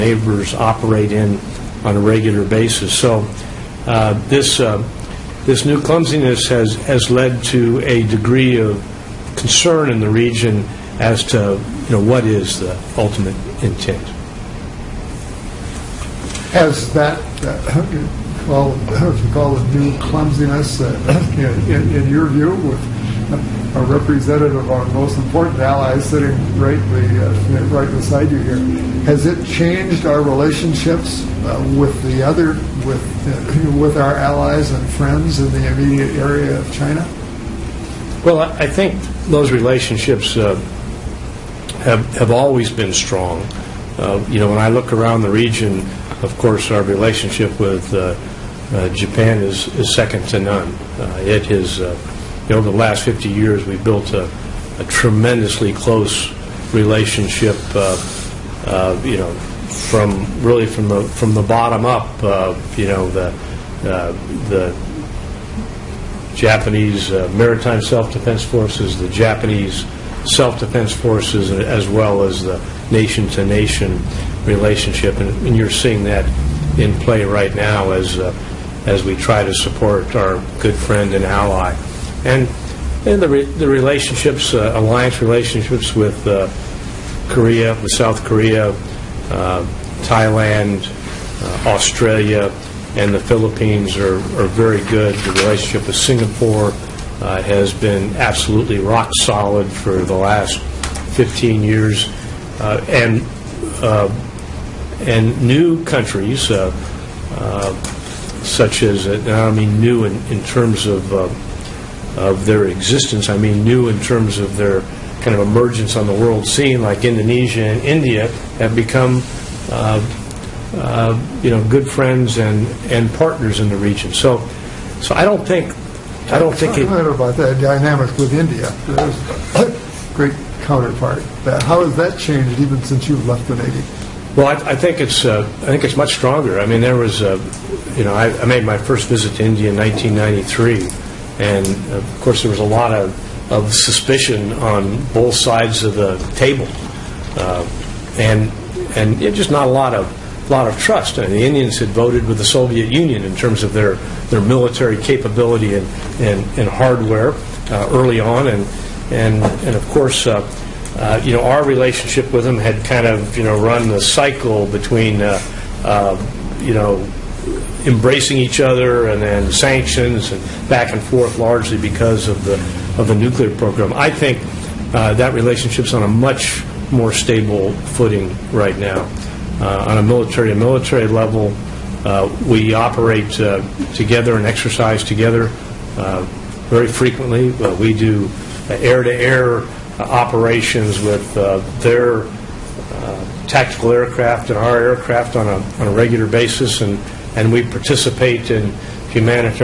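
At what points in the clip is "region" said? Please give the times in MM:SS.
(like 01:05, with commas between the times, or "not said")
00:10, 00:45, 02:03.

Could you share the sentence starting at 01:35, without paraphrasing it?
The relationship with Singapore uh, has been absolutely rock solid for the last 15 years.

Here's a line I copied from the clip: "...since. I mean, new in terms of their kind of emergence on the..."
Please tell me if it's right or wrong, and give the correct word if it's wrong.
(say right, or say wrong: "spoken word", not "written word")
wrong: "existence", not "since".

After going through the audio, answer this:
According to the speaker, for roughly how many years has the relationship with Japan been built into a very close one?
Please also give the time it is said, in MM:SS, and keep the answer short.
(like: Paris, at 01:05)
50 years, at 00:53.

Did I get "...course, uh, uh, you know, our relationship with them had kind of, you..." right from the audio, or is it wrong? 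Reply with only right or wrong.
right.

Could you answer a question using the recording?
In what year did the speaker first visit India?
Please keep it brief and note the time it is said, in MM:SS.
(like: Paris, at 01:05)
1993, at 02:19.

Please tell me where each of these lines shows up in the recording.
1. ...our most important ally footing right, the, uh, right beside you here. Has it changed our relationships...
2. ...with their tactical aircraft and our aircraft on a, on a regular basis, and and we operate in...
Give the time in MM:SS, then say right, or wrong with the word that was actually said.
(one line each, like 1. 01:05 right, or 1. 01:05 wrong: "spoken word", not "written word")
1. 00:24 wrong: "sitting", not "footing"
2. 03:11 wrong: "participate", not "operate".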